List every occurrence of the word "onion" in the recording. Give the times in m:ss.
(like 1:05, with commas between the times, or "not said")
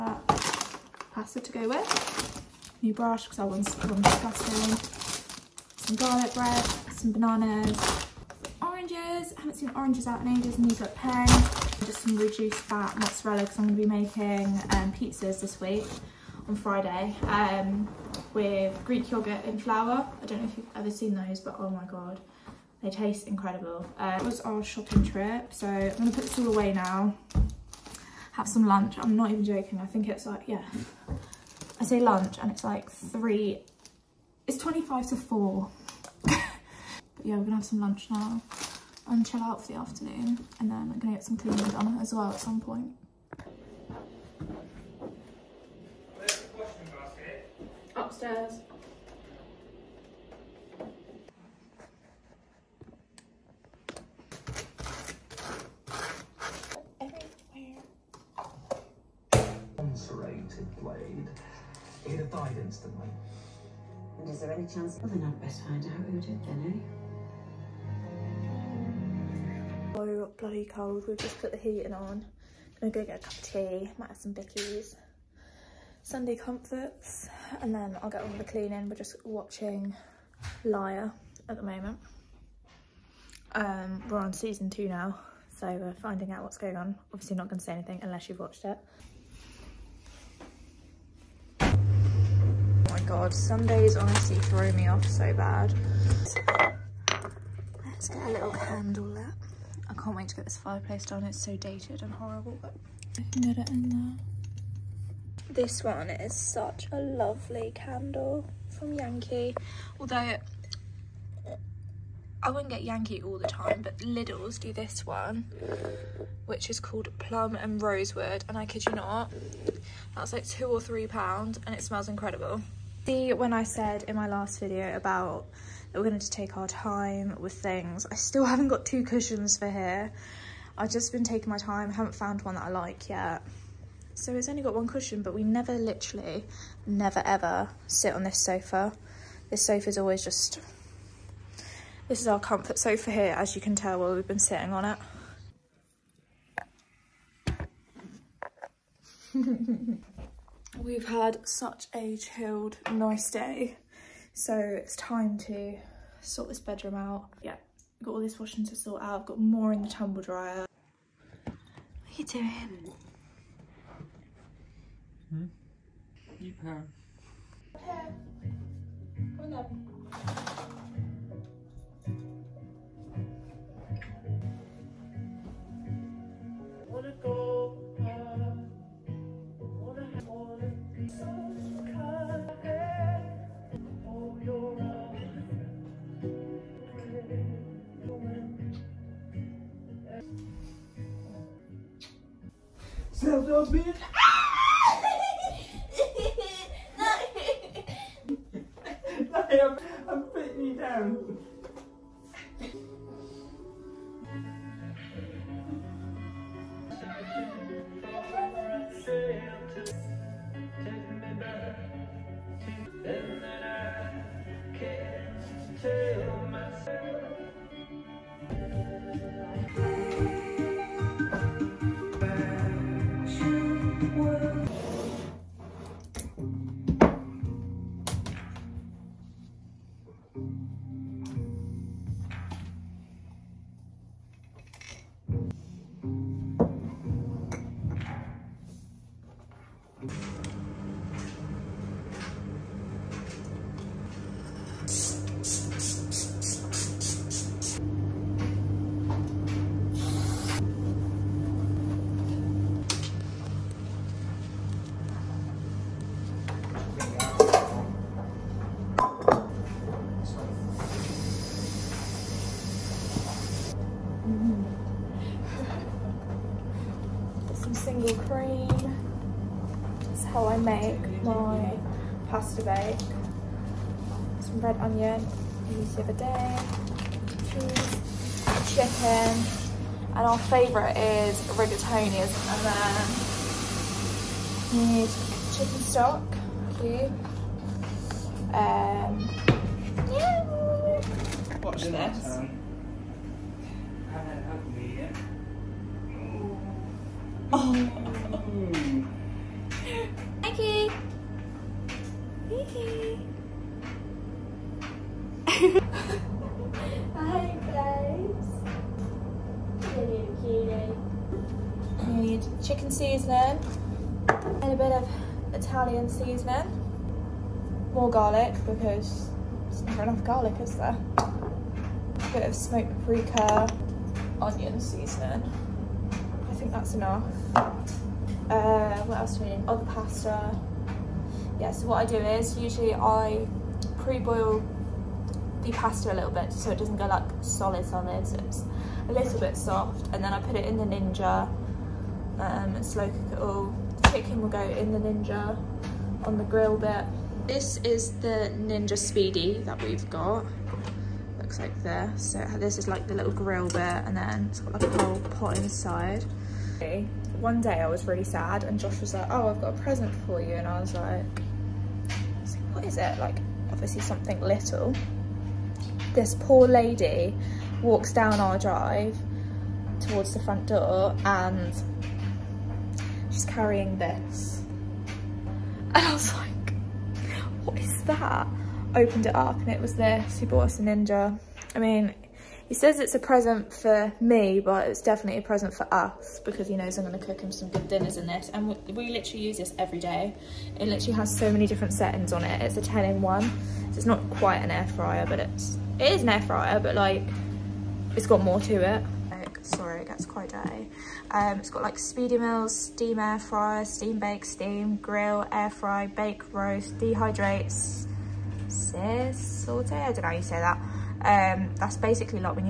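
4:34, 5:24.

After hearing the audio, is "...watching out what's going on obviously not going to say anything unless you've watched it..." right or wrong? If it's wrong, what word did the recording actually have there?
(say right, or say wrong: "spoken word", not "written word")
wrong: "finding", not "watching".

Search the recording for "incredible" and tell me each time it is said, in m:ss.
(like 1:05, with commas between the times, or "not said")
0:23, 2:02.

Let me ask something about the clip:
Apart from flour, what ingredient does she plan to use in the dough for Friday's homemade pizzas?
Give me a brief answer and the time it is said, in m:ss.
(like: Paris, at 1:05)
Greek yogurt, at 0:18.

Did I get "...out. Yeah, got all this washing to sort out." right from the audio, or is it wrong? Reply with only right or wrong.
right.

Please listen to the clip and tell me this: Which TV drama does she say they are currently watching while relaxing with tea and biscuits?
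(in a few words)
Liar.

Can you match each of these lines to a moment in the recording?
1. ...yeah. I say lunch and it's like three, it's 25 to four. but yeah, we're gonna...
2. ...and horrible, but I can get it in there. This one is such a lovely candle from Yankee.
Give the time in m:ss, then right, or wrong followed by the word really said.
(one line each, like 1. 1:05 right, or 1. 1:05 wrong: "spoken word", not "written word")
1. 0:30 right
2. 1:42 right.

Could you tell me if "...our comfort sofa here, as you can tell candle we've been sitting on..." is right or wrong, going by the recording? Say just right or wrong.
wrong.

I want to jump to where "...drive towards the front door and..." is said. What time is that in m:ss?
6:08.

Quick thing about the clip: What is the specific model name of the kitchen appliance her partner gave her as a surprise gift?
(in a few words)
Ninja Speedi.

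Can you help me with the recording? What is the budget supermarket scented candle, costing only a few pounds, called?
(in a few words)
Plum and Rosewood.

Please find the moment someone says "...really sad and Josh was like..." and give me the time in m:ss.
5:58.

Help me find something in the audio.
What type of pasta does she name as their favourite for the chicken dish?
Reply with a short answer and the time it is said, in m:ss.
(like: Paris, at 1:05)
Rigatoni, at 4:41.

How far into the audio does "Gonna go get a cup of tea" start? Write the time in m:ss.
1:12.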